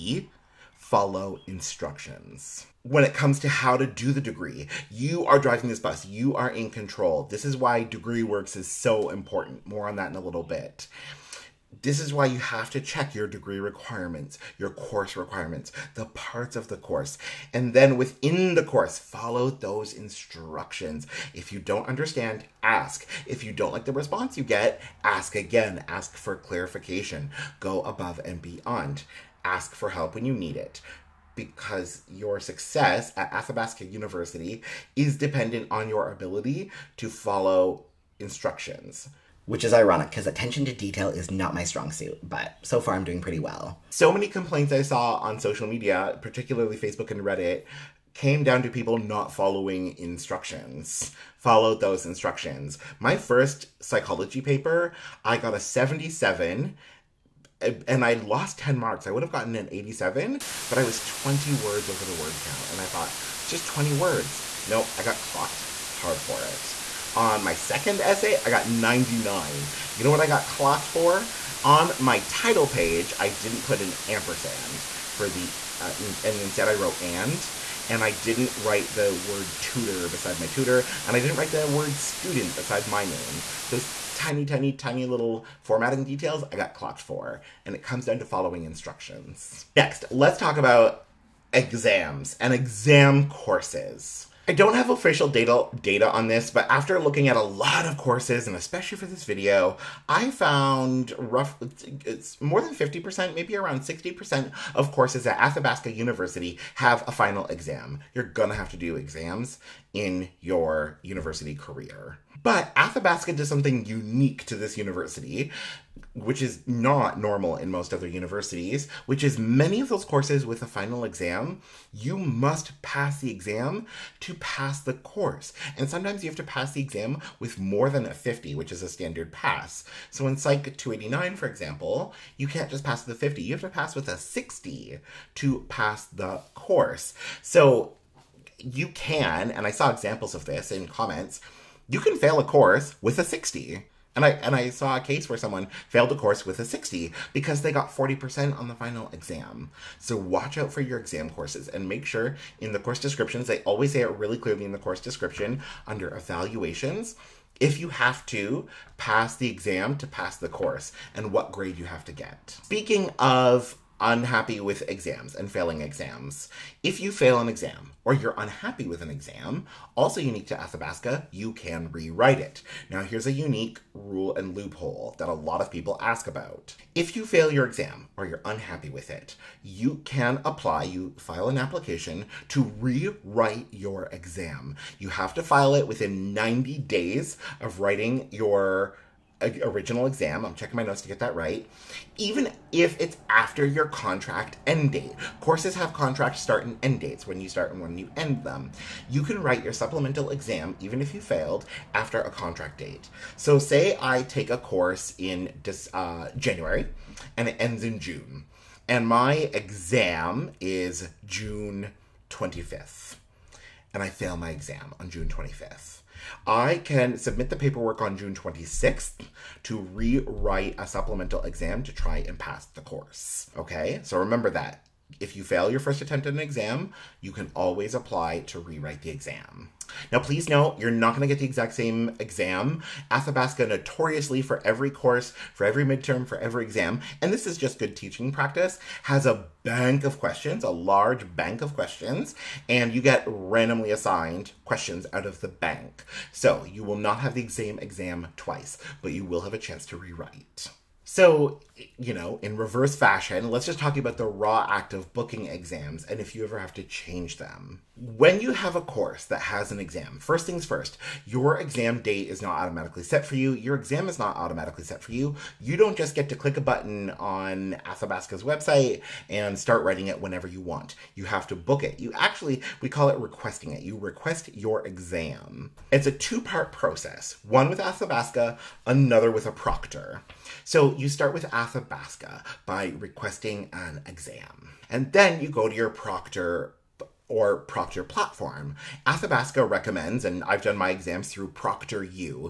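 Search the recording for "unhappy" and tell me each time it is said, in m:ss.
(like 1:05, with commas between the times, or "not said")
2:43, 2:48, 2:58.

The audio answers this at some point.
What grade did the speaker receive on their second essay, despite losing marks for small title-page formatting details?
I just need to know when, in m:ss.
1:08.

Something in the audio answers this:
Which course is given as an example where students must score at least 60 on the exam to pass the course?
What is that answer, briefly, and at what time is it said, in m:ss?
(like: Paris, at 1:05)
Psych 289, at 2:10.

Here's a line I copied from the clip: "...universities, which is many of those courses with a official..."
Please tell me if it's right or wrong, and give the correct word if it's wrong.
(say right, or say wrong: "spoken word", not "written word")
wrong: "final", not "official".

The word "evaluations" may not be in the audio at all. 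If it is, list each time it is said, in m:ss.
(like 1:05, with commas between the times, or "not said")
2:36.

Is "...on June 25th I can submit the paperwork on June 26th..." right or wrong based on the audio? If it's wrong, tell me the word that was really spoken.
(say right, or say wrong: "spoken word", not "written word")
right.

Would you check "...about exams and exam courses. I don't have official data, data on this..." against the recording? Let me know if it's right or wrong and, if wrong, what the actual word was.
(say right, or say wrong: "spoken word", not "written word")
right.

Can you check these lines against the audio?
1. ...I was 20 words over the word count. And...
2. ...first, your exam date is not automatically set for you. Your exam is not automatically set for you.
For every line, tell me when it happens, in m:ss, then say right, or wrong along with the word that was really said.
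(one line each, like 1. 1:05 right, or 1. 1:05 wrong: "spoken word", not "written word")
1. 1:00 right
2. 4:20 right.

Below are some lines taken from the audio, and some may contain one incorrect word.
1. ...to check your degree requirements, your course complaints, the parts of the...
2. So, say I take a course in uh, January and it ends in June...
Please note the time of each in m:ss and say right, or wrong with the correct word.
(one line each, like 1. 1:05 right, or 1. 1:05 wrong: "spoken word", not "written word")
1. 0:12 wrong: "requirements", not "complaints"
2. 3:23 right.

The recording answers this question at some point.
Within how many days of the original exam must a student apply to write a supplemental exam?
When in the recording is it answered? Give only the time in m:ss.
3:06.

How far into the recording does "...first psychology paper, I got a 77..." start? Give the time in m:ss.
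0:53.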